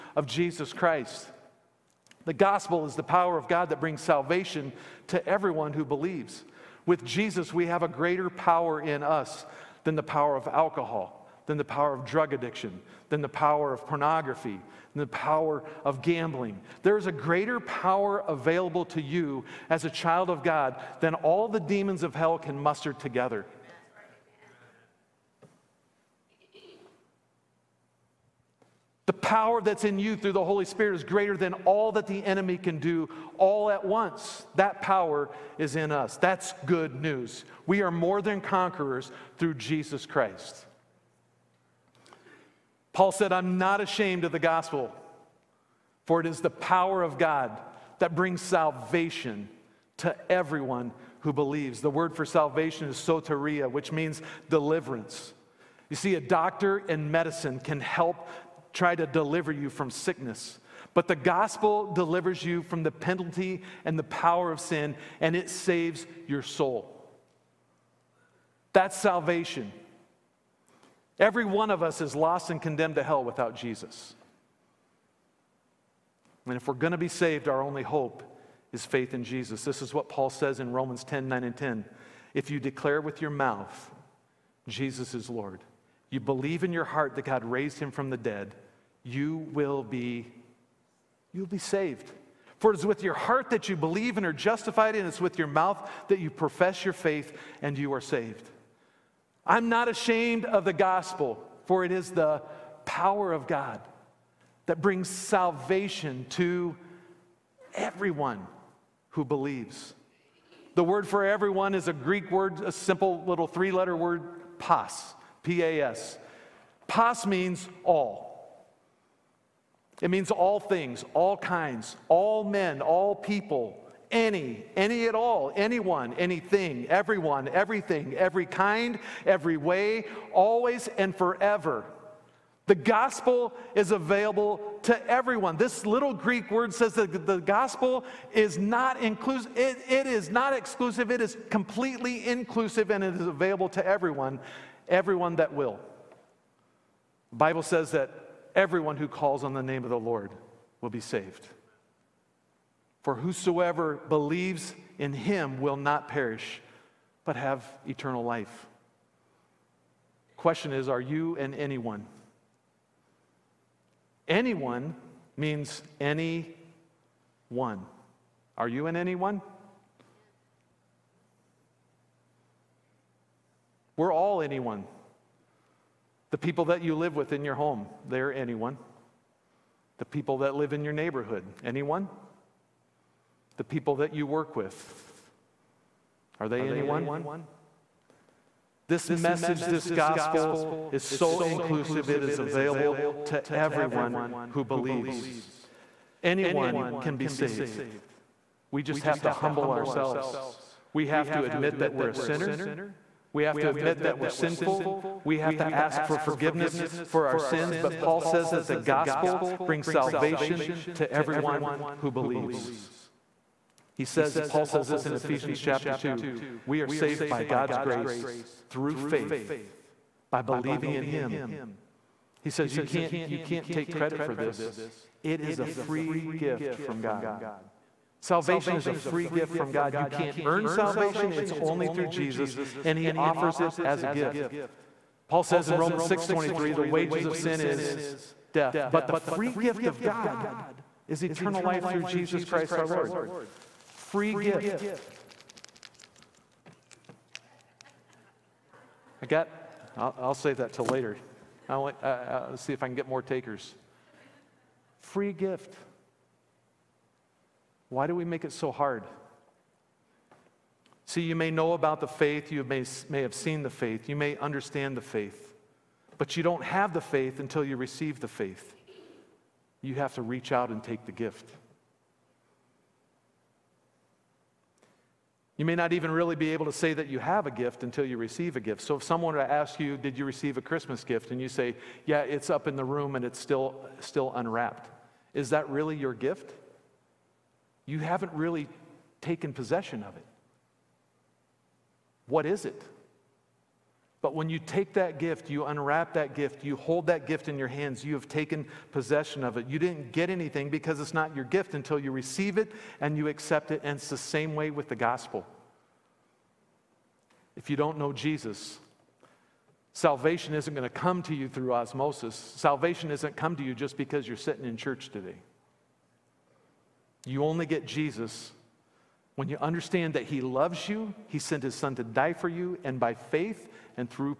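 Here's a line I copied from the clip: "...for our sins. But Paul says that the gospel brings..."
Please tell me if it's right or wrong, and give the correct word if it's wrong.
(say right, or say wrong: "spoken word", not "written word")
right.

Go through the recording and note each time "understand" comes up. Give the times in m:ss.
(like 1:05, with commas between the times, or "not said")
4:24, 5:19.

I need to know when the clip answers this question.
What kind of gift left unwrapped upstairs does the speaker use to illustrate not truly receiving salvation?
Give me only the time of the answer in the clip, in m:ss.
4:40.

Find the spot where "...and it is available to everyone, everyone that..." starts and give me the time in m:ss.
2:22.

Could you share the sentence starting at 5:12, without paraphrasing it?
Salvation isn't come to you just because you're sitting in church today.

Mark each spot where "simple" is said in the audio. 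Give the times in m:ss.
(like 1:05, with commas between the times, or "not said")
1:52.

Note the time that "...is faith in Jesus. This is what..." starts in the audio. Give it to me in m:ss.
1:18.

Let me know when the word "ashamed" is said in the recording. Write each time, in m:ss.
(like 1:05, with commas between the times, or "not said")
0:43, 1:39.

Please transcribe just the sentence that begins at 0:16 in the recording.
There is a greater power available to you as a child of God than all the demons of hell can muster together.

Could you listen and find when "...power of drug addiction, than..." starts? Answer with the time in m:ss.
0:11.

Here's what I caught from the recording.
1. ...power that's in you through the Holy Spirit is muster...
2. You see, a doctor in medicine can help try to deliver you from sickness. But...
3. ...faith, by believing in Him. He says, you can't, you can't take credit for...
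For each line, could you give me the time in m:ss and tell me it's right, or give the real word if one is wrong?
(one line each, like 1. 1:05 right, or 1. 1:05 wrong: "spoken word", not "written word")
1. 0:29 wrong: "greater", not "muster"
2. 0:55 right
3. 3:38 right.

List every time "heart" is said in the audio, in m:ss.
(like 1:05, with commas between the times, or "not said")
1:26, 1:33.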